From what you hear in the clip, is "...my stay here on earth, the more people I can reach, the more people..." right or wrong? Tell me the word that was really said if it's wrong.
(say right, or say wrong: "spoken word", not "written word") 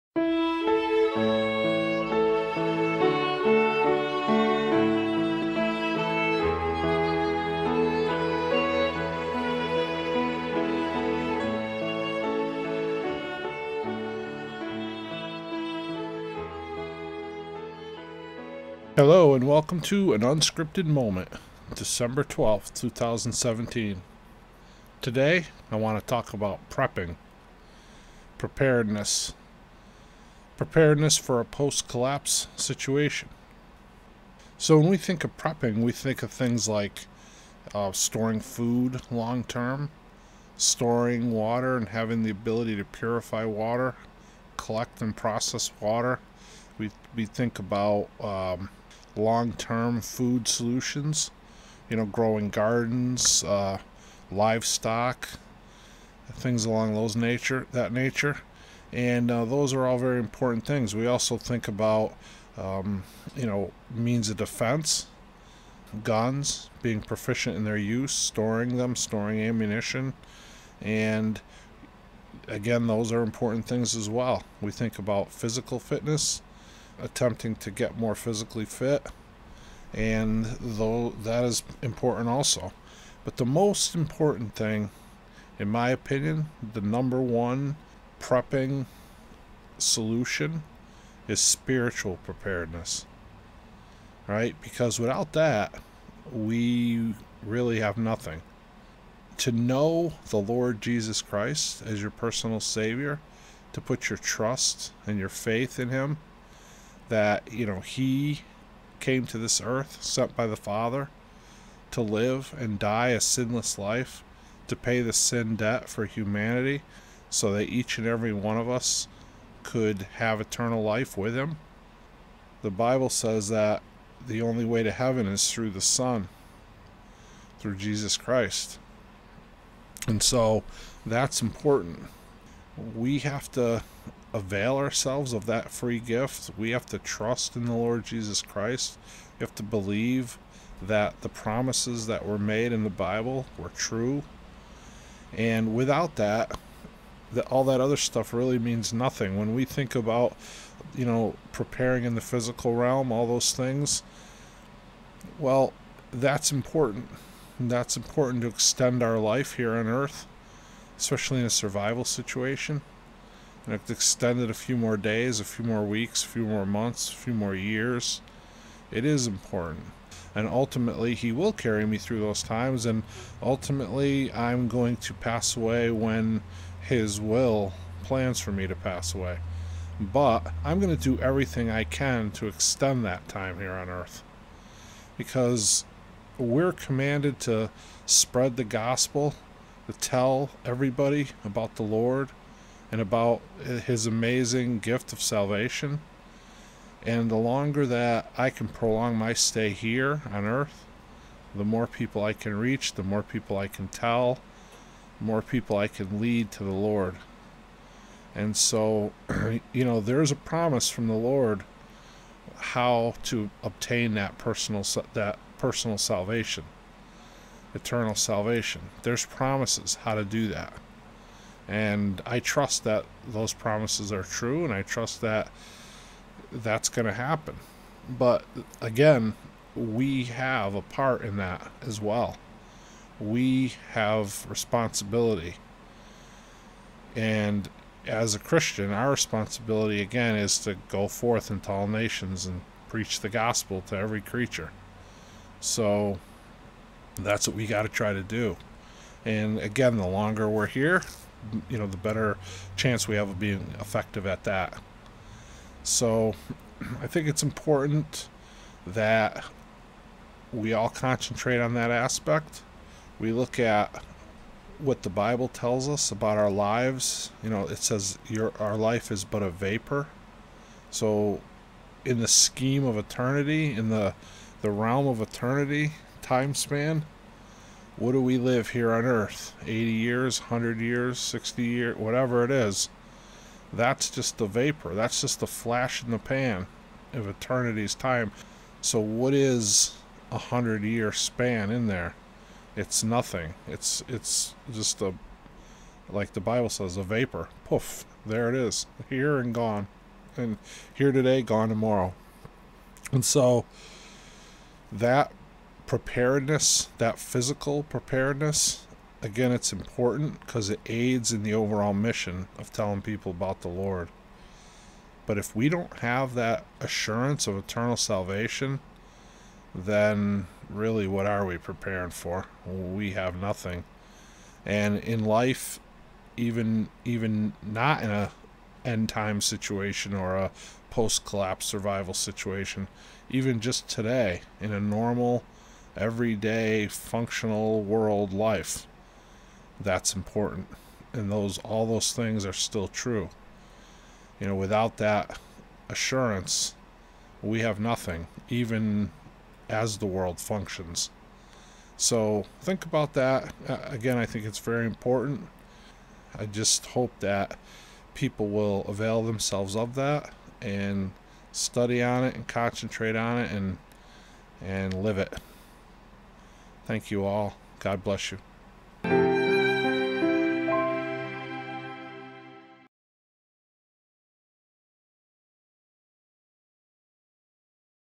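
right.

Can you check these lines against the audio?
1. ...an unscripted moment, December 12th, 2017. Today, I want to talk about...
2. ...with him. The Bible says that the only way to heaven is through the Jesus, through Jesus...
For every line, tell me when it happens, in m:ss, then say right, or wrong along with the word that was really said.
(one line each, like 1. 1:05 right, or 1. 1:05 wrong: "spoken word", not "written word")
1. 0:20 right
2. 2:01 wrong: "Son", not "Jesus".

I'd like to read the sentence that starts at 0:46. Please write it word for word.
We, we think about um, long-term food solutions.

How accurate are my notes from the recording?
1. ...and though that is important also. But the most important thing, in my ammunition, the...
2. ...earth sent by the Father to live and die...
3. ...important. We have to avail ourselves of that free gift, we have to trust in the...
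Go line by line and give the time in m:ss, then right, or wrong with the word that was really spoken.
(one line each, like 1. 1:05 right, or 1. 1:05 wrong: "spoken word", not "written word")
1. 1:19 wrong: "opinion", not "ammunition"
2. 1:49 right
3. 2:11 right.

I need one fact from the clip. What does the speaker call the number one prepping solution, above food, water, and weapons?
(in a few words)
Spiritual preparedness.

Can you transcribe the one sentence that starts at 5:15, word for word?
But if we don't have that assurance of eternal salvation, then really what are we preparing for?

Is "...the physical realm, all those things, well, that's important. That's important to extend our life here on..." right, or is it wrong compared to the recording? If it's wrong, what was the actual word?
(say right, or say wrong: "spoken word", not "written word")
right.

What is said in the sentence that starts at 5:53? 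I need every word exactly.
Again, I think it's very important.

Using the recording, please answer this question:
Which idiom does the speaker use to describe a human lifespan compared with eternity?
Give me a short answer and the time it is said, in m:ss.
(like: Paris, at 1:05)
Flash in the pan, at 4:45.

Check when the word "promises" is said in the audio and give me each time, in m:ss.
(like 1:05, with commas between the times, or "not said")
2:21, 3:30, 3:39, 3:43.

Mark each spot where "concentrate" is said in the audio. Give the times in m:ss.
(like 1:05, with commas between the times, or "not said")
4:20, 6:02.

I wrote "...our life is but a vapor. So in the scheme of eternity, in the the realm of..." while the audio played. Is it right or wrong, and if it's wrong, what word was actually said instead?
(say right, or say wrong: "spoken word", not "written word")
right.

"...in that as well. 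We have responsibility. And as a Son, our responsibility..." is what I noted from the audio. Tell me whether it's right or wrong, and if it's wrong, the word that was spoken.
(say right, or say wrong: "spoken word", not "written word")
wrong: "Christian", not "Son".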